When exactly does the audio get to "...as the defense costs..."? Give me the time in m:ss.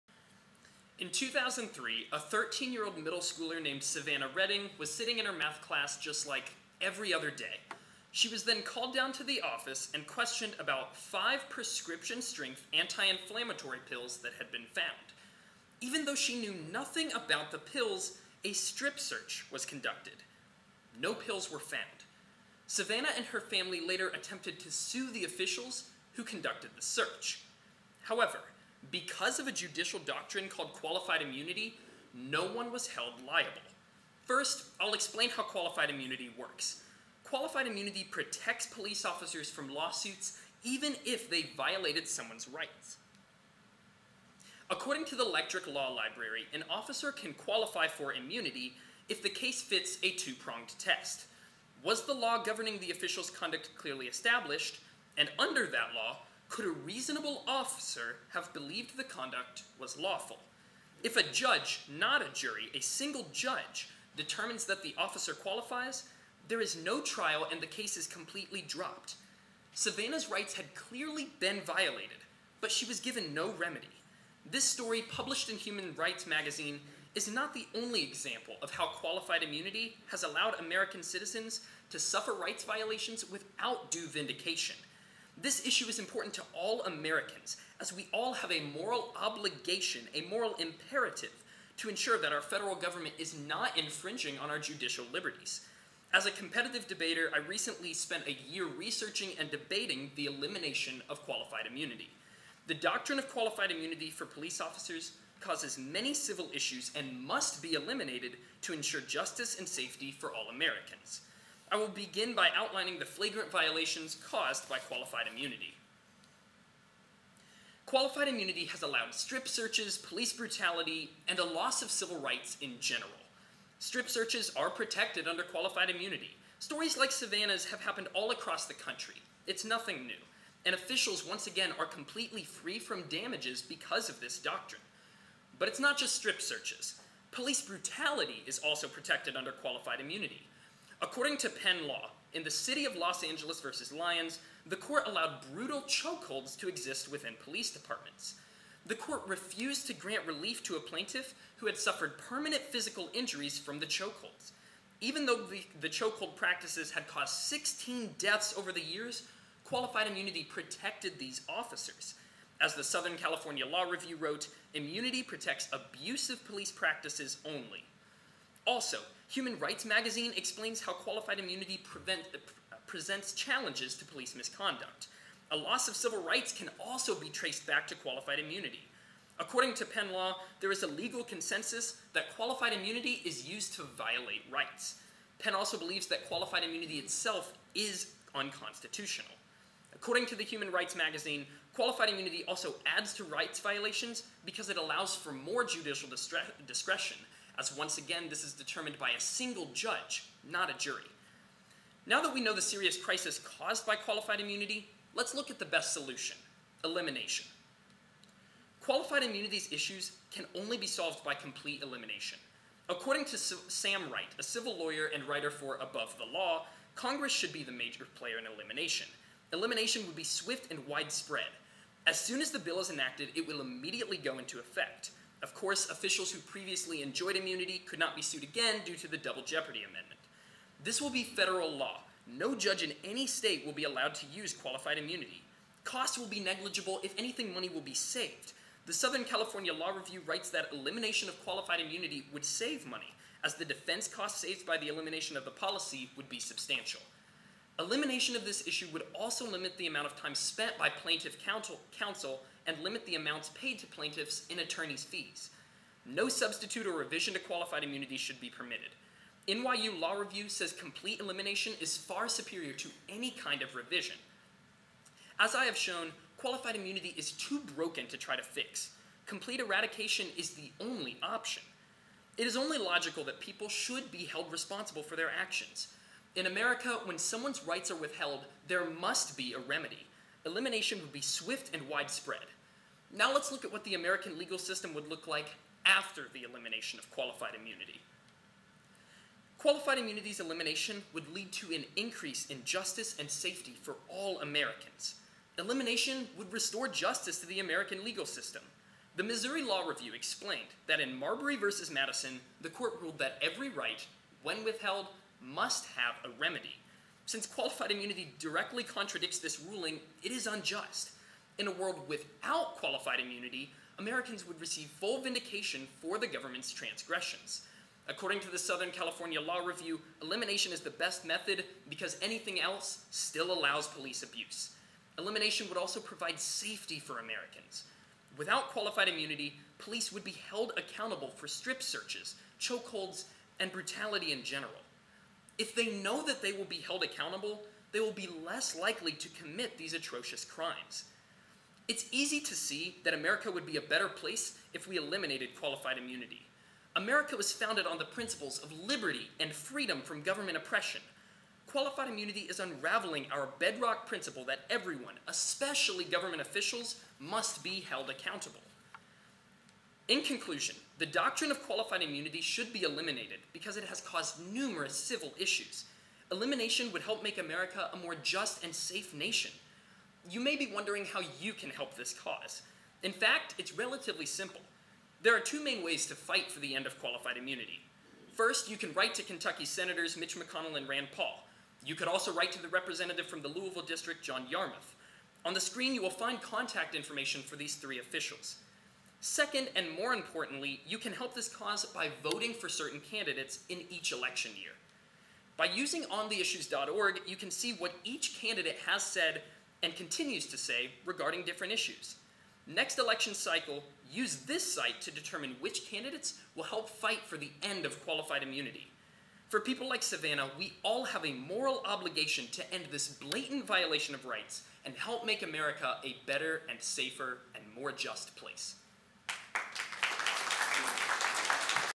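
4:03.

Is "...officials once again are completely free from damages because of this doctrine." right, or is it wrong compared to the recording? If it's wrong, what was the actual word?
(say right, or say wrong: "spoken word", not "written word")
right.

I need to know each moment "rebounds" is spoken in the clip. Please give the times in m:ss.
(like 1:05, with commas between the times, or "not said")
not said.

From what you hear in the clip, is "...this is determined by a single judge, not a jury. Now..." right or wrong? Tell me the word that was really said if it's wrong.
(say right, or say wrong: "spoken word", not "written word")
right.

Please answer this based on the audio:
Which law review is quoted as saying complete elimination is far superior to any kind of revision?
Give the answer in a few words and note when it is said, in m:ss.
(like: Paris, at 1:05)
NYU Law Review, at 4:19.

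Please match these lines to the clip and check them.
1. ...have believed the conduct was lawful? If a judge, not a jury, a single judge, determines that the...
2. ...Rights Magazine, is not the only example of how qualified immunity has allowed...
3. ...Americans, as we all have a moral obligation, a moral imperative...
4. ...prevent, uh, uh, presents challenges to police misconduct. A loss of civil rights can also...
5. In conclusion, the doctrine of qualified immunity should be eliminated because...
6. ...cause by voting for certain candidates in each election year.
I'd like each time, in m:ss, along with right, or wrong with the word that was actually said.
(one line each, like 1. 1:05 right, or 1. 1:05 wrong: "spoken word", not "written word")
1. 0:58 right
2. 1:15 right
3. 1:26 right
4. 2:51 right
5. 6:00 right
6. 6:31 right.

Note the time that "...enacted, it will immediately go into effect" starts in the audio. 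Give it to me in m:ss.
3:42.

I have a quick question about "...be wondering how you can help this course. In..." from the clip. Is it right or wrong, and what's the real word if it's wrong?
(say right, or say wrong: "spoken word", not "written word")
wrong: "cause", not "course".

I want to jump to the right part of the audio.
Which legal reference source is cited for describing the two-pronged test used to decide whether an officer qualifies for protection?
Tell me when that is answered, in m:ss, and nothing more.
0:45.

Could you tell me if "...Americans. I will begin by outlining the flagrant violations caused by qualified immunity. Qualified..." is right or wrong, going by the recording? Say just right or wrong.
right.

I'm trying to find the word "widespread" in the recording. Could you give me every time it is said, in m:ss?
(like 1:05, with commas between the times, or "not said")
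3:40, 4:41.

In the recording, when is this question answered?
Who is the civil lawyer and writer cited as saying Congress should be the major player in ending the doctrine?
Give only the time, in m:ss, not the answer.
3:33.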